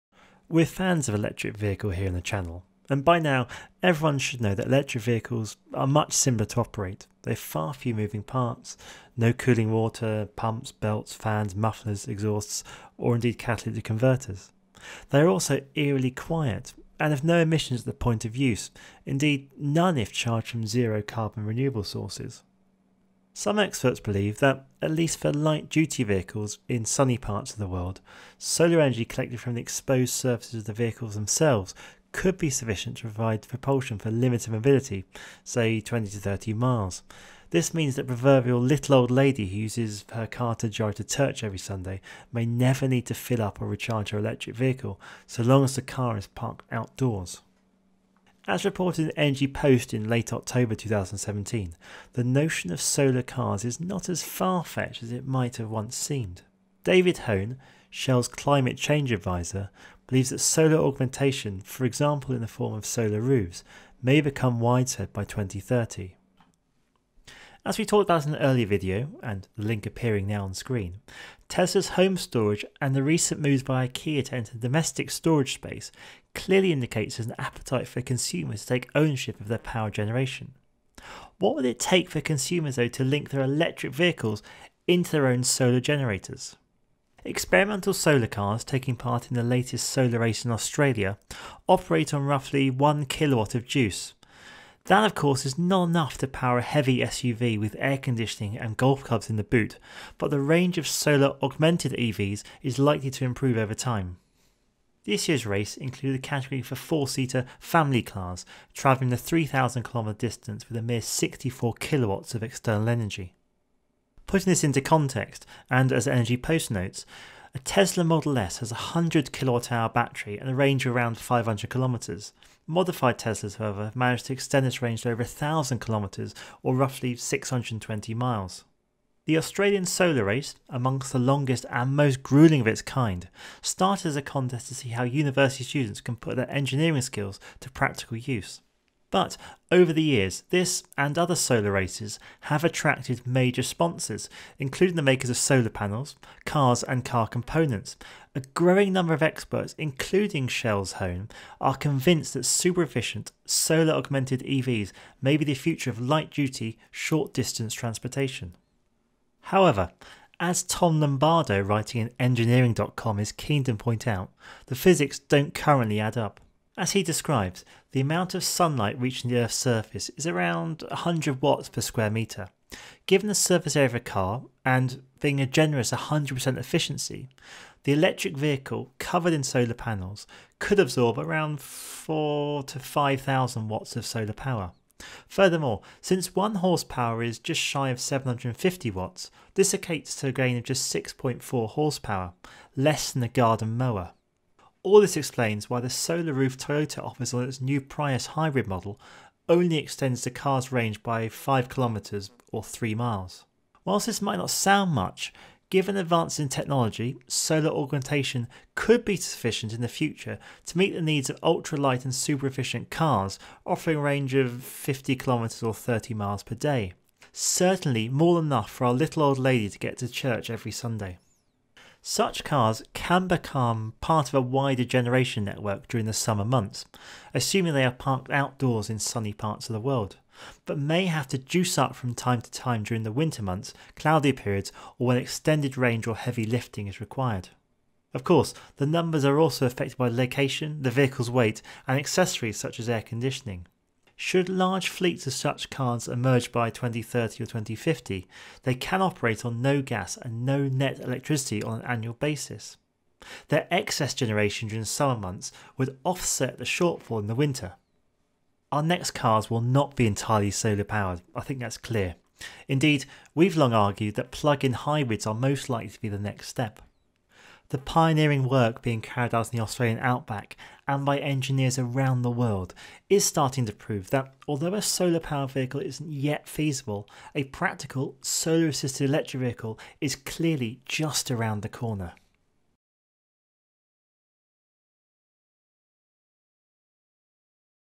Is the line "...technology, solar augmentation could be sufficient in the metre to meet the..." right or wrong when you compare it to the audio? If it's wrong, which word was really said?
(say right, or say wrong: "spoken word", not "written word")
wrong: "future", not "metre".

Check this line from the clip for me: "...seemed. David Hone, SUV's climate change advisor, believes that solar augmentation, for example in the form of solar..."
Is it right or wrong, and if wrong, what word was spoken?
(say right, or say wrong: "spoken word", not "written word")
wrong: "Shell", not "SUV".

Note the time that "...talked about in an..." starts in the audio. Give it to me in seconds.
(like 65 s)
67 s.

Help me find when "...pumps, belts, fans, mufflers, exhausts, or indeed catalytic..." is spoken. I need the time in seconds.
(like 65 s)
10 s.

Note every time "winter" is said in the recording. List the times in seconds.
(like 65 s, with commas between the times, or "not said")
233 s, 257 s.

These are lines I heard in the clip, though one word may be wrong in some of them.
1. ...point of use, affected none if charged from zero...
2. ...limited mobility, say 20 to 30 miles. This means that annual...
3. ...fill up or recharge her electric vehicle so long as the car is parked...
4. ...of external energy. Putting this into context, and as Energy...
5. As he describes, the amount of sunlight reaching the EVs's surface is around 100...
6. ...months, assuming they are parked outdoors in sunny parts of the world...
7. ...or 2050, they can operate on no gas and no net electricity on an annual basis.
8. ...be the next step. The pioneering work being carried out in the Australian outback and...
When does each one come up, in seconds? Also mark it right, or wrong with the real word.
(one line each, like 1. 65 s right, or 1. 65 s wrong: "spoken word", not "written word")
1. 17 s wrong: "indeed", not "affected"
2. 34 s wrong: "proverbial", not "annual"
3. 43 s right
4. 112 s right
5. 166 s wrong: "Earth", not "EVs"
6. 226 s right
7. 247 s right
8. 266 s right.